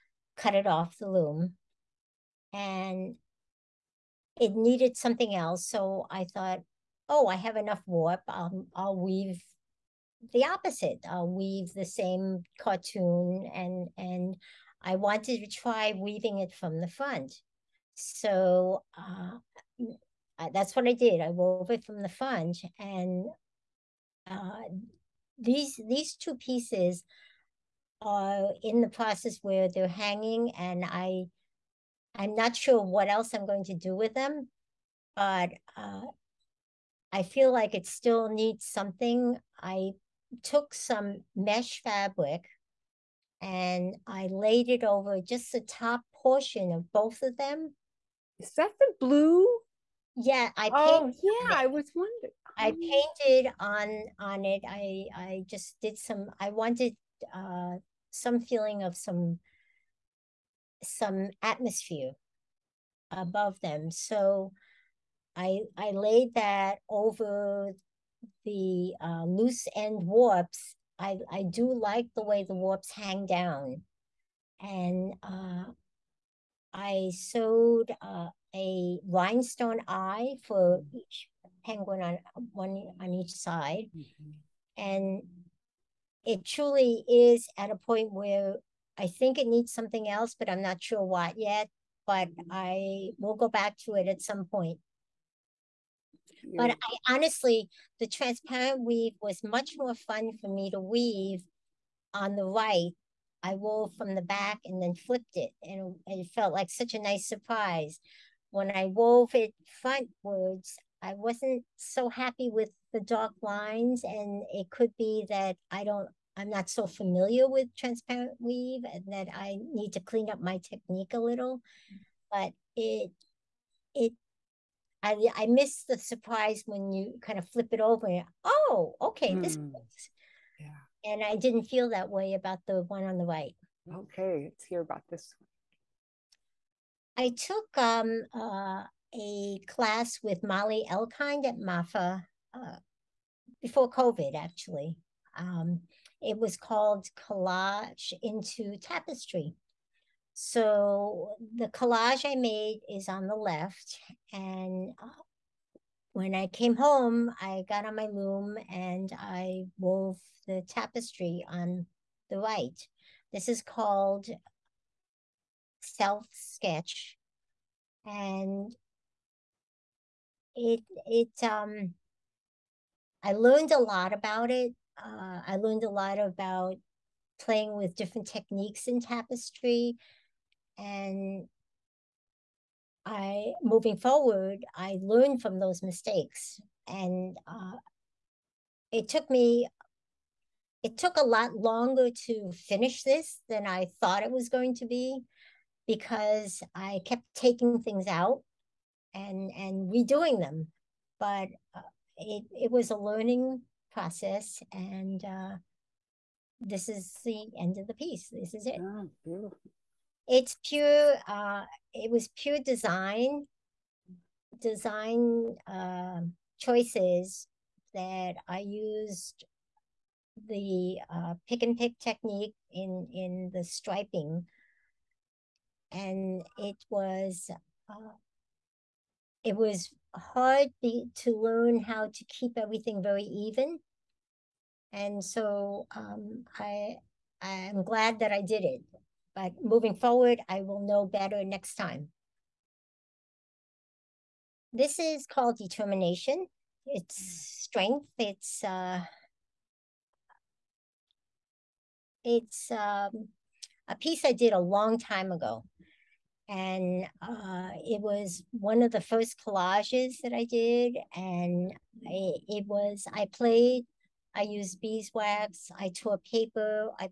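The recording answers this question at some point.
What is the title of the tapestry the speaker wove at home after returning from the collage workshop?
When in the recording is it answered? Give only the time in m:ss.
2:45.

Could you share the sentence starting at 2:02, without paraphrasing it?
but it it I, I miss the surprise when you kind of flip it over.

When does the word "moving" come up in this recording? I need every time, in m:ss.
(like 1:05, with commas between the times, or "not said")
3:03, 3:59.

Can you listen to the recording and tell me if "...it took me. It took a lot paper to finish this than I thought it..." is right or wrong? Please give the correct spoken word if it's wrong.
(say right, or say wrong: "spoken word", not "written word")
wrong: "longer", not "paper".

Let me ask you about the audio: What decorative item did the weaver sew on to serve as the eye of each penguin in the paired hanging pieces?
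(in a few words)
rhinestone.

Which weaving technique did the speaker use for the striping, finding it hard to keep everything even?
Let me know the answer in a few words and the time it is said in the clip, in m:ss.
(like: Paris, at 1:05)
pick and pick, at 3:41.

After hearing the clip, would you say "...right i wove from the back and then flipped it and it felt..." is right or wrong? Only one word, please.
right.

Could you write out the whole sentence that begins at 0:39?
I took some mesh fabric and I laid it over just the top portion of both of them.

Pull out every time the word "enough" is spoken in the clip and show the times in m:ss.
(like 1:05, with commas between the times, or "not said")
0:07.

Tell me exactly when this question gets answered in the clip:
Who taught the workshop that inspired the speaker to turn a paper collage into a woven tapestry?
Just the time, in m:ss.
2:20.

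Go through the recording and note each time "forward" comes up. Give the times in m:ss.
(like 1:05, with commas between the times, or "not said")
3:03, 3:59.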